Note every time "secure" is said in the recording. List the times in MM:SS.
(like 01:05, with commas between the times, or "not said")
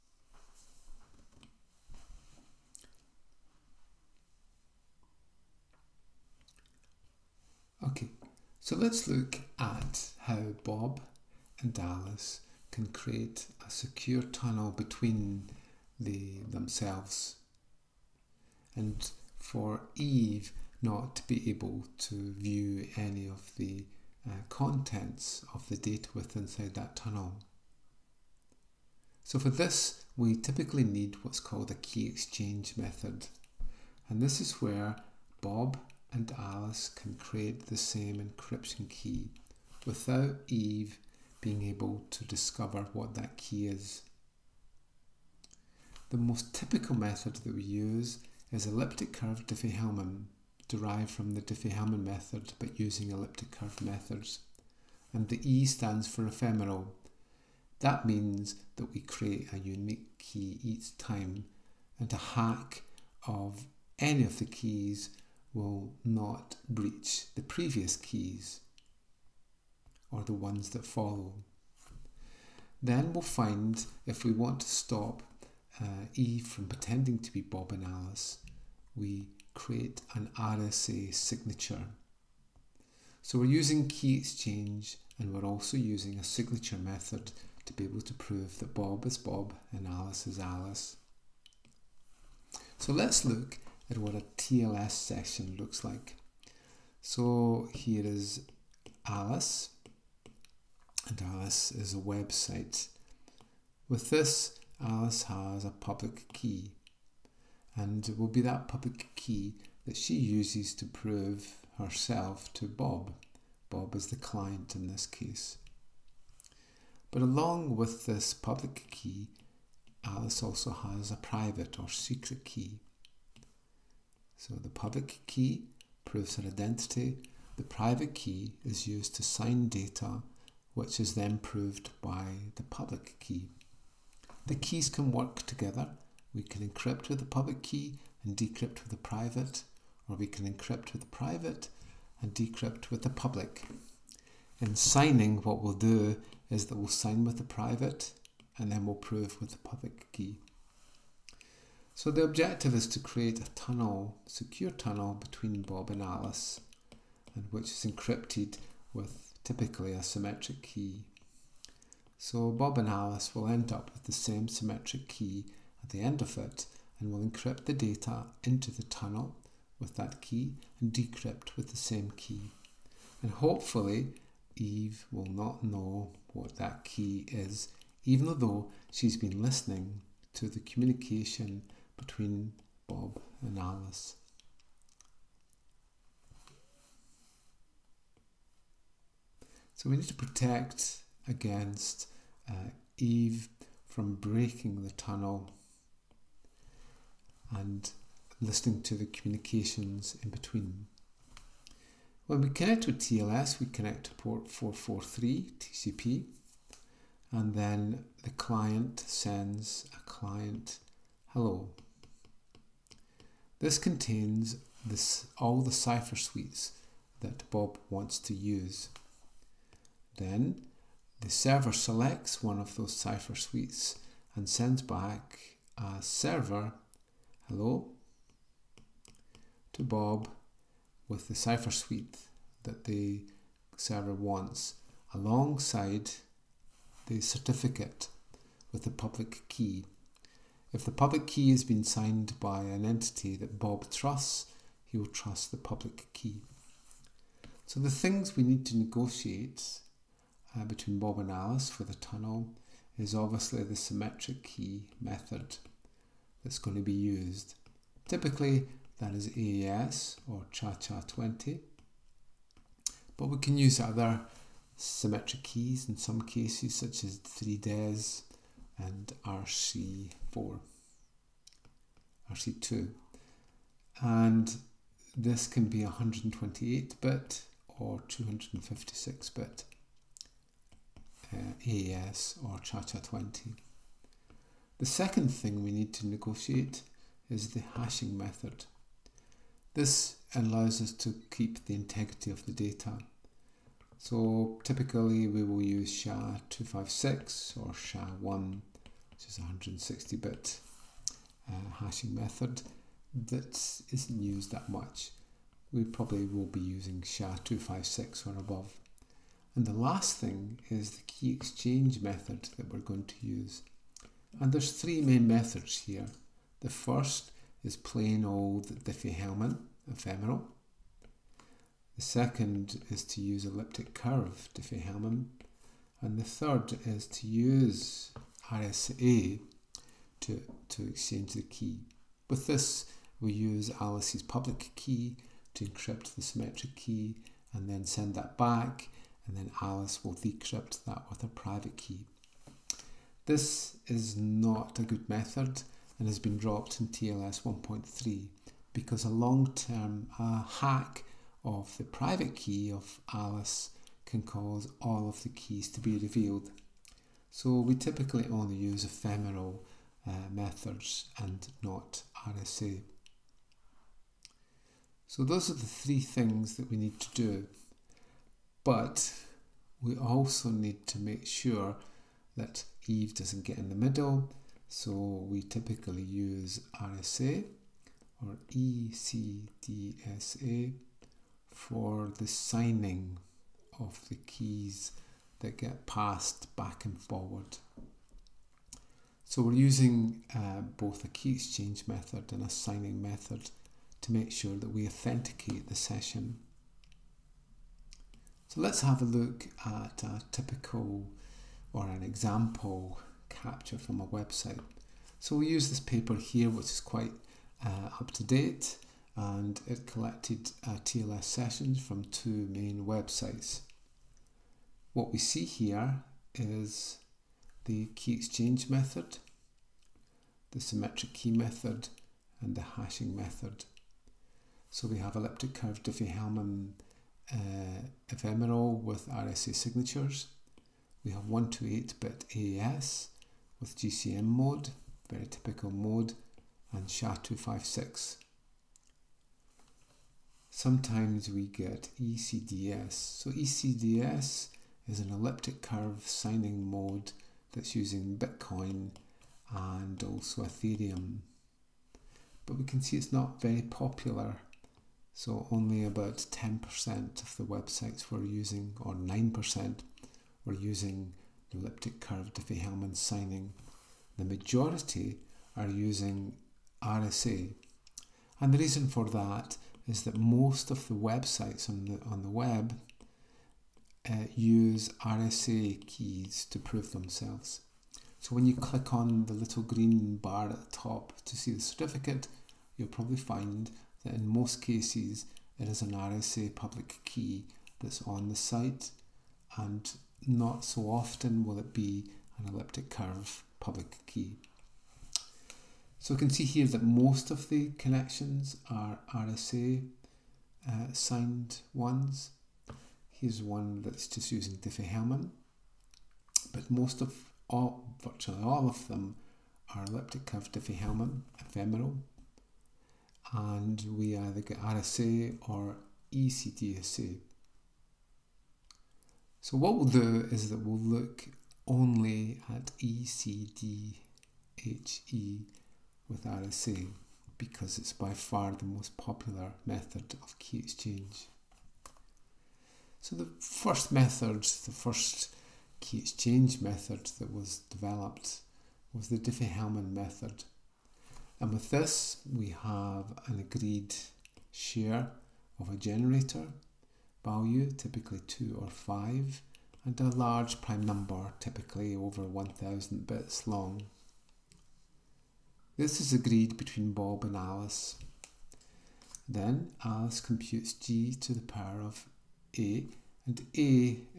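00:13, 02:34.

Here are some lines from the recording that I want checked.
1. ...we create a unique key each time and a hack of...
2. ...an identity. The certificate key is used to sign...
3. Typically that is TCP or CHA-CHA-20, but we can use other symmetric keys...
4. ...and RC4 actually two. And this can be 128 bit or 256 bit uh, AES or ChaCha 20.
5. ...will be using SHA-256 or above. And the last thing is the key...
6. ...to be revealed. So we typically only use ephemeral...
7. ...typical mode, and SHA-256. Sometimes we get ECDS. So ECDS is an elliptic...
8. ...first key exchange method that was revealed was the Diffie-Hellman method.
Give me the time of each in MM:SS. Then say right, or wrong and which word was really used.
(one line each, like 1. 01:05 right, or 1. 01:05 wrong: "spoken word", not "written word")
1. 00:58 right
2. 02:06 wrong: "private", not "certificate"
3. 04:18 wrong: "AES", not "TCP"
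4. 04:28 right
5. 05:06 right
6. 05:55 right
7. 07:15 right
8. 08:54 wrong: "developed", not "revealed".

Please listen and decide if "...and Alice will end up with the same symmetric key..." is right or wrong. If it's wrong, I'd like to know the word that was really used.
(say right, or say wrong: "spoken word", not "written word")
right.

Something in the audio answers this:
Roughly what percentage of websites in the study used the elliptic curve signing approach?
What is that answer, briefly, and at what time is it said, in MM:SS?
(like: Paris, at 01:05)
9%, at 07:38.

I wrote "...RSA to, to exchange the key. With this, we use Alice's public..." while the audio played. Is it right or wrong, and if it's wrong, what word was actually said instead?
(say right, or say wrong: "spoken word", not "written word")
right.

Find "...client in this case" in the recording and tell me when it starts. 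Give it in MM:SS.
01:54.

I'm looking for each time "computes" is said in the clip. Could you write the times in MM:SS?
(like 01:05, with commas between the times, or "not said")
09:20.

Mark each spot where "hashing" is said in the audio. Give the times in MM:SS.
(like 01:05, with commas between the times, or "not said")
04:47, 05:01, 07:02.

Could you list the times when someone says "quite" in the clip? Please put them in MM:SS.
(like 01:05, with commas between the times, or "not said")
06:46.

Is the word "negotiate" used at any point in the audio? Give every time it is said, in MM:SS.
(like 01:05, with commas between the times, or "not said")
04:08, 04:46.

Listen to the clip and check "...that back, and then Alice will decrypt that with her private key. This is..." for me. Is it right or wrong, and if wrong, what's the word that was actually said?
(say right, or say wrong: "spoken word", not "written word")
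right.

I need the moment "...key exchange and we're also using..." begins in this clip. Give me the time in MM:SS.
01:23.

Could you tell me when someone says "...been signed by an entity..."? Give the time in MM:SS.
04:01.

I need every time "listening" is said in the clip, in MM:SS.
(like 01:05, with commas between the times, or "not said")
02:59, 03:18.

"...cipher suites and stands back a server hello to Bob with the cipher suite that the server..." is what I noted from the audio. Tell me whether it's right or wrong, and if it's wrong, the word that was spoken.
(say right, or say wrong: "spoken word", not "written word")
wrong: "sends", not "stands".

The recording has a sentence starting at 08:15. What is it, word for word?
So you can see here that most of the connections are RSA uh, signed ones.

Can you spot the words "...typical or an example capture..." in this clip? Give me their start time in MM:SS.
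06:40.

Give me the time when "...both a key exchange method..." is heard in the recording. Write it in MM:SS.
06:30.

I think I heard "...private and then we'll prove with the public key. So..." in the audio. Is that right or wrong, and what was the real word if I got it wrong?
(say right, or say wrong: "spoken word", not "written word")
right.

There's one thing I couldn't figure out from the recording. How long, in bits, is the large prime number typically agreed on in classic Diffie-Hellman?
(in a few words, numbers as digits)
over 1000 bits.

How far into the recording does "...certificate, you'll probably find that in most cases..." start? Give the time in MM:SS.
08:01.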